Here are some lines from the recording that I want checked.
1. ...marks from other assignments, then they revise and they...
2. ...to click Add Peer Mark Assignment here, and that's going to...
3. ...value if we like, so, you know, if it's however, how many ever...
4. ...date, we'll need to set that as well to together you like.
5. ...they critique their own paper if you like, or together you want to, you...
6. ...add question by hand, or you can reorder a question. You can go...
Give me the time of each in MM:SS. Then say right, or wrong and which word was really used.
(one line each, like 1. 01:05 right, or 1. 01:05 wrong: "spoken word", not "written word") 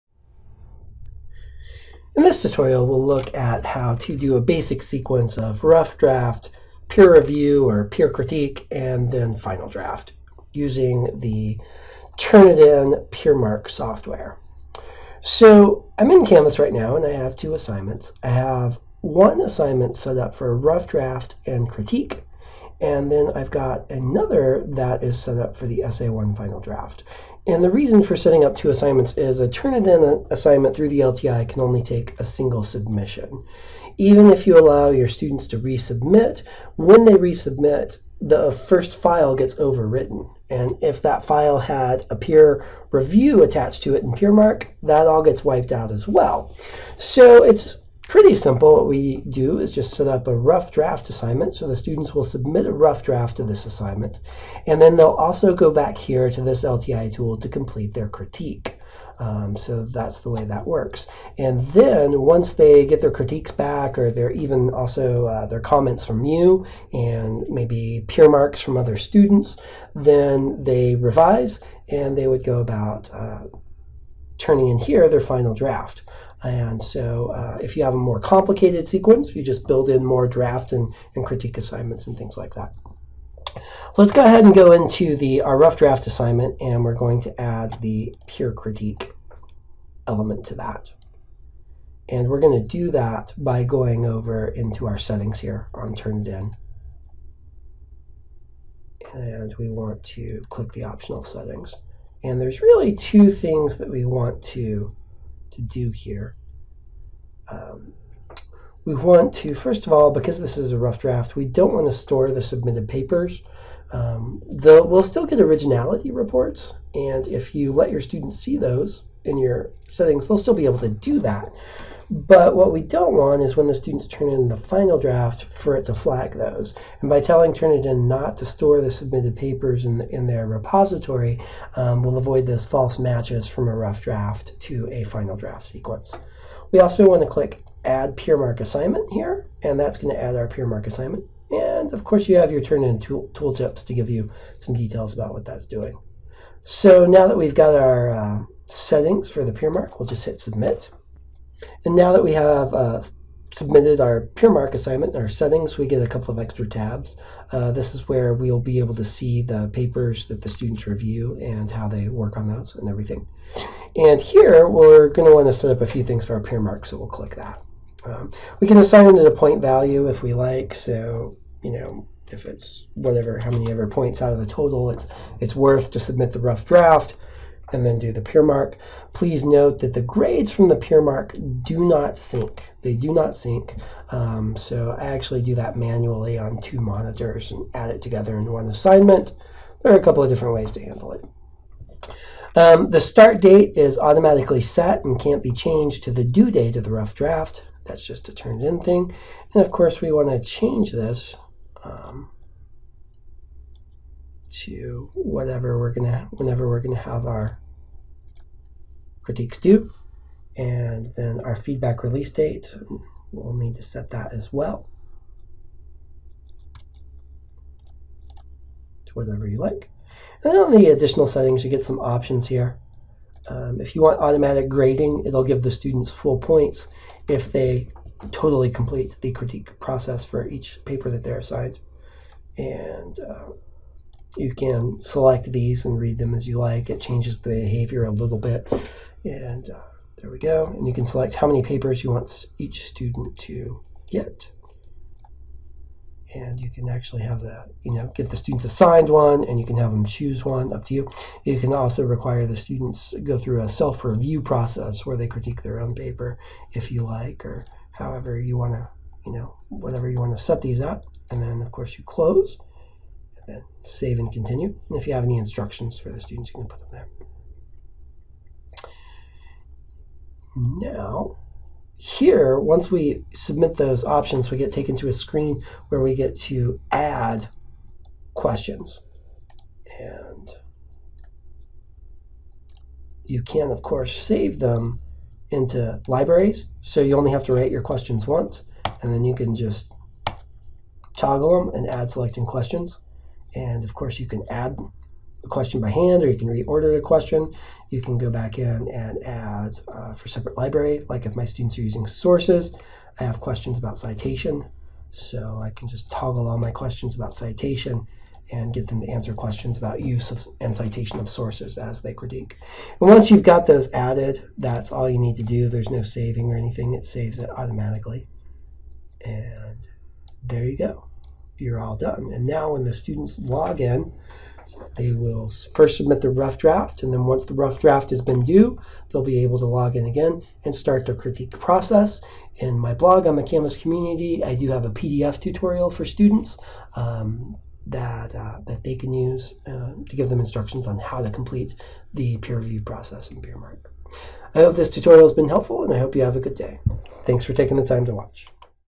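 1. 01:08 wrong: "students", not "assignments"
2. 02:17 right
3. 02:49 wrong: "whatever", not "however"
4. 03:32 wrong: "whatever", not "together"
5. 04:15 wrong: "however", not "together"
6. 04:54 right.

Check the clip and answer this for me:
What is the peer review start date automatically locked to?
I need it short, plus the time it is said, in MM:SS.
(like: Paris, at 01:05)
Due date of the rough draft, at 03:16.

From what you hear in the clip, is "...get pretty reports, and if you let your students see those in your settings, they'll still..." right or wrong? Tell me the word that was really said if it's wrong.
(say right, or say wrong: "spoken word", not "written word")
wrong: "originality", not "pretty".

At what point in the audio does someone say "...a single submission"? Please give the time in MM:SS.
00:32.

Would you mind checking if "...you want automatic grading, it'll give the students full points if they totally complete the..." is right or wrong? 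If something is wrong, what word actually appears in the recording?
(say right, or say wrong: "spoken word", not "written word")
right.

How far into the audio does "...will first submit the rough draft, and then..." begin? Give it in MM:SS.
05:25.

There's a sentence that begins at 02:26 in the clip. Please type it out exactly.
So now that we've got our uh, settings for the peer mark, we'll just hit Submit.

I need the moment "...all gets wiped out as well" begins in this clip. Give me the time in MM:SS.
00:45.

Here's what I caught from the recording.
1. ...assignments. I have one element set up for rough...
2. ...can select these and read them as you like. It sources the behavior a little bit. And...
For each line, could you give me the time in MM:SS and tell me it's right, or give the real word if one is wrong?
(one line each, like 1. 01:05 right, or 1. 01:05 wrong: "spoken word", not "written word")
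1. 00:17 wrong: "assignment", not "element"
2. 03:54 wrong: "changes", not "sources".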